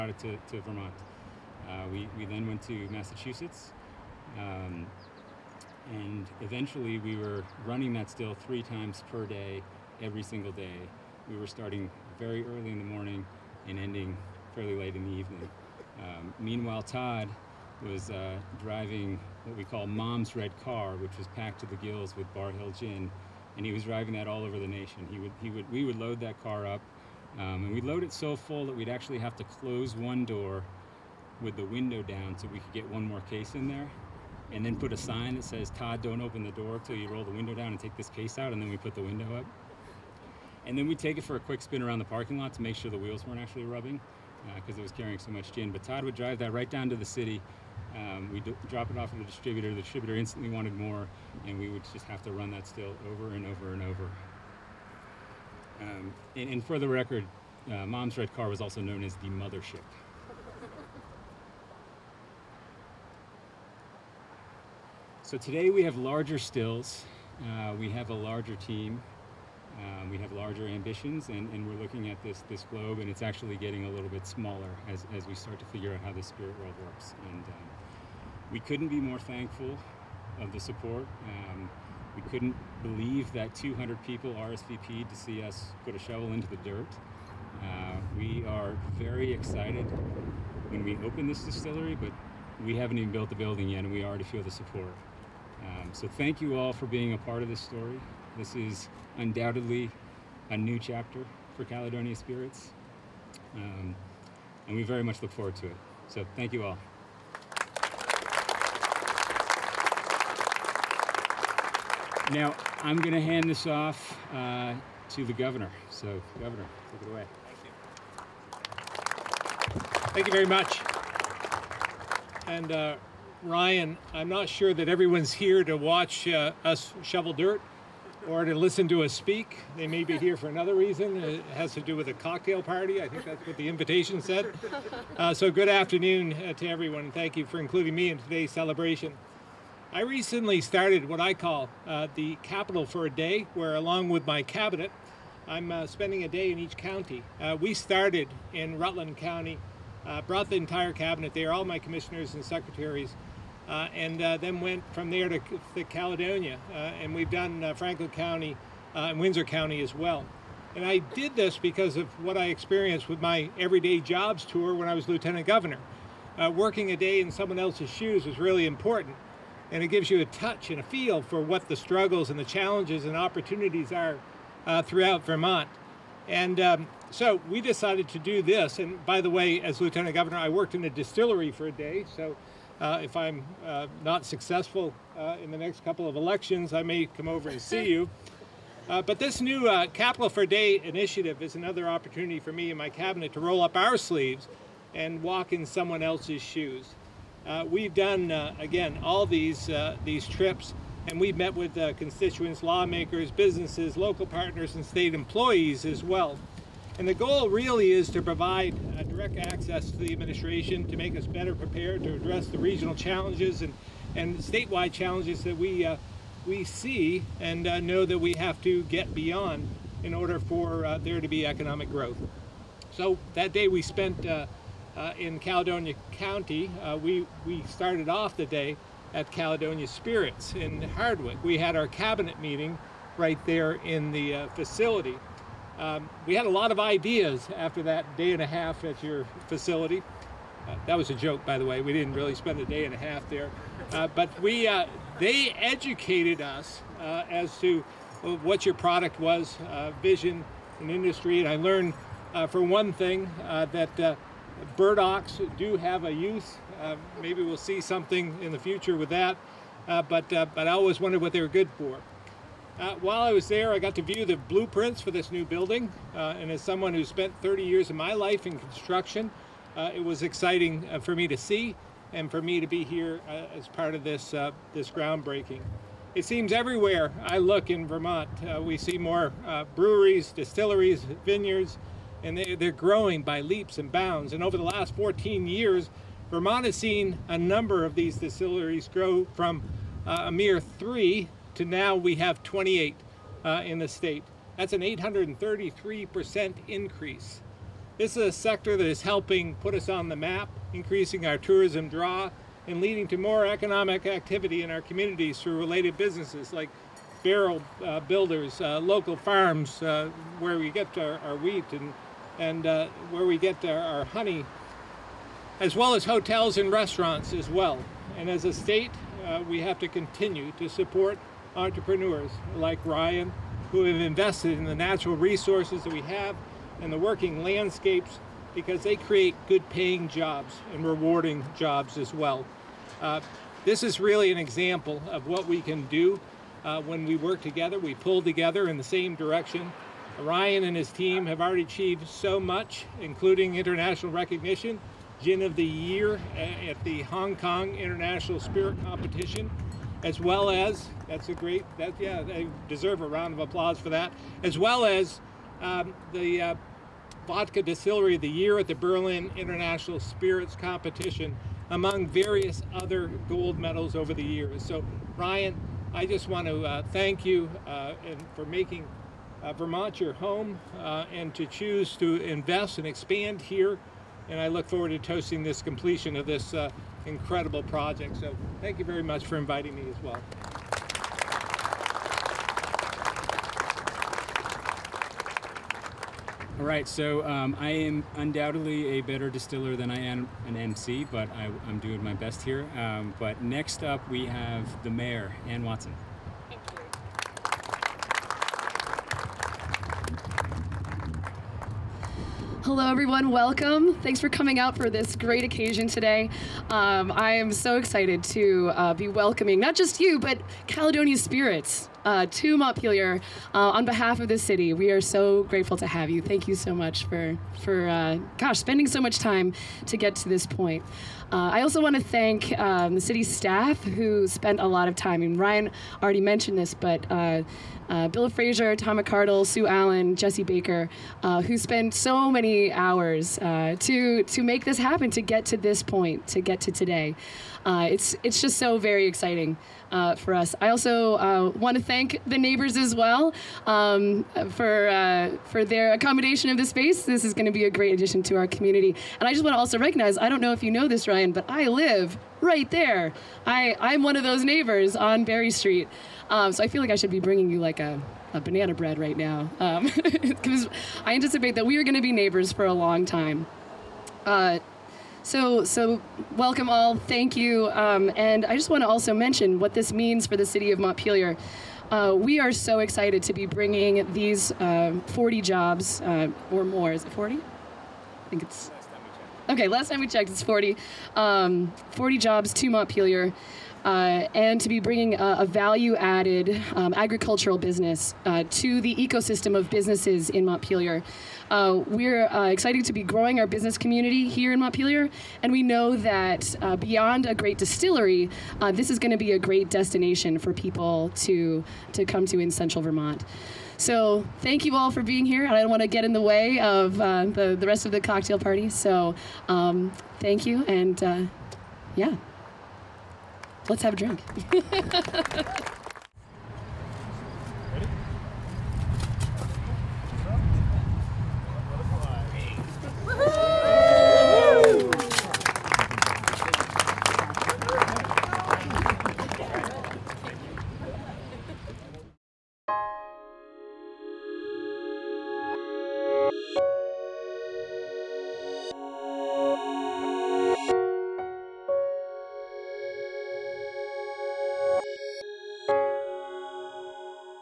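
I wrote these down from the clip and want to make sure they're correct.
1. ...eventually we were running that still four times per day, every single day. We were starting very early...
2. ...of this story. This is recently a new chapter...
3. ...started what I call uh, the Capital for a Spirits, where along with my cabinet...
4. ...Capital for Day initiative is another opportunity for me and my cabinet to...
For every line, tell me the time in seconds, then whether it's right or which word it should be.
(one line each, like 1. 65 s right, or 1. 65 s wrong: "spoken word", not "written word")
1. 6 s wrong: "three", not "four"
2. 97 s wrong: "undoubtedly", not "recently"
3. 140 s wrong: "Day", not "Spirits"
4. 189 s right.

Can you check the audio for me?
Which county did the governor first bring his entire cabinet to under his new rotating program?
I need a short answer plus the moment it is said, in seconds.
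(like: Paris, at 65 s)
Rutland County, at 148 s.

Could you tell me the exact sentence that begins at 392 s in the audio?
Um, but next up, we have the mayor, Anne Watson.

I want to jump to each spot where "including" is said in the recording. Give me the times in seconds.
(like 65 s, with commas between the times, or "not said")
137 s, 342 s.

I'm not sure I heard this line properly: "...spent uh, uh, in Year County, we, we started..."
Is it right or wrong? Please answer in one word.
wrong.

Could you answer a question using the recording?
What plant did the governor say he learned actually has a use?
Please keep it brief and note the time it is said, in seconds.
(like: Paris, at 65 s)
burdocks, at 254 s.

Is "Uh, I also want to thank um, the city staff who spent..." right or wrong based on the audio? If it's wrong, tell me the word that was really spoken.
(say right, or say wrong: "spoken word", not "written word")
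right.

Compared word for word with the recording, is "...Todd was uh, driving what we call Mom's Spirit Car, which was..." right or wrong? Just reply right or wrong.
wrong.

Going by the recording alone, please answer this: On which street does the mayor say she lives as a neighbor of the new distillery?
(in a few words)
Berry Street.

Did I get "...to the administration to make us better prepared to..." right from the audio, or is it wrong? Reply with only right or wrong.
right.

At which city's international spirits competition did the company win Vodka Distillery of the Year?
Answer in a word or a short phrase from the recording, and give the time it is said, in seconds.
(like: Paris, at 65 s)
Berlin, at 358 s.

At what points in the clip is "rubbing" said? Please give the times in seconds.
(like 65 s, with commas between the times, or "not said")
43 s.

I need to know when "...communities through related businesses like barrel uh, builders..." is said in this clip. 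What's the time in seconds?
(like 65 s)
304 s.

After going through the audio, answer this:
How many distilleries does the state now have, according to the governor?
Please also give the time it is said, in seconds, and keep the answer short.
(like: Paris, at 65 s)
28, at 292 s.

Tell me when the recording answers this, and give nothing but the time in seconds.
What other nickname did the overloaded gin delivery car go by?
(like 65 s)
59 s.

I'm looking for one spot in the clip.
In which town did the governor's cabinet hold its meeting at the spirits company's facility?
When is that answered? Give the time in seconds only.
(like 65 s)
230 s.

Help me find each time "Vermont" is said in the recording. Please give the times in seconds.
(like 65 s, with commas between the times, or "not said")
0 s, 175 s, 277 s, 286 s, 369 s, 502 s.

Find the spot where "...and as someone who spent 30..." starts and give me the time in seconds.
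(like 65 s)
266 s.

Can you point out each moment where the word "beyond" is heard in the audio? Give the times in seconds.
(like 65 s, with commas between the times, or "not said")
219 s, 496 s.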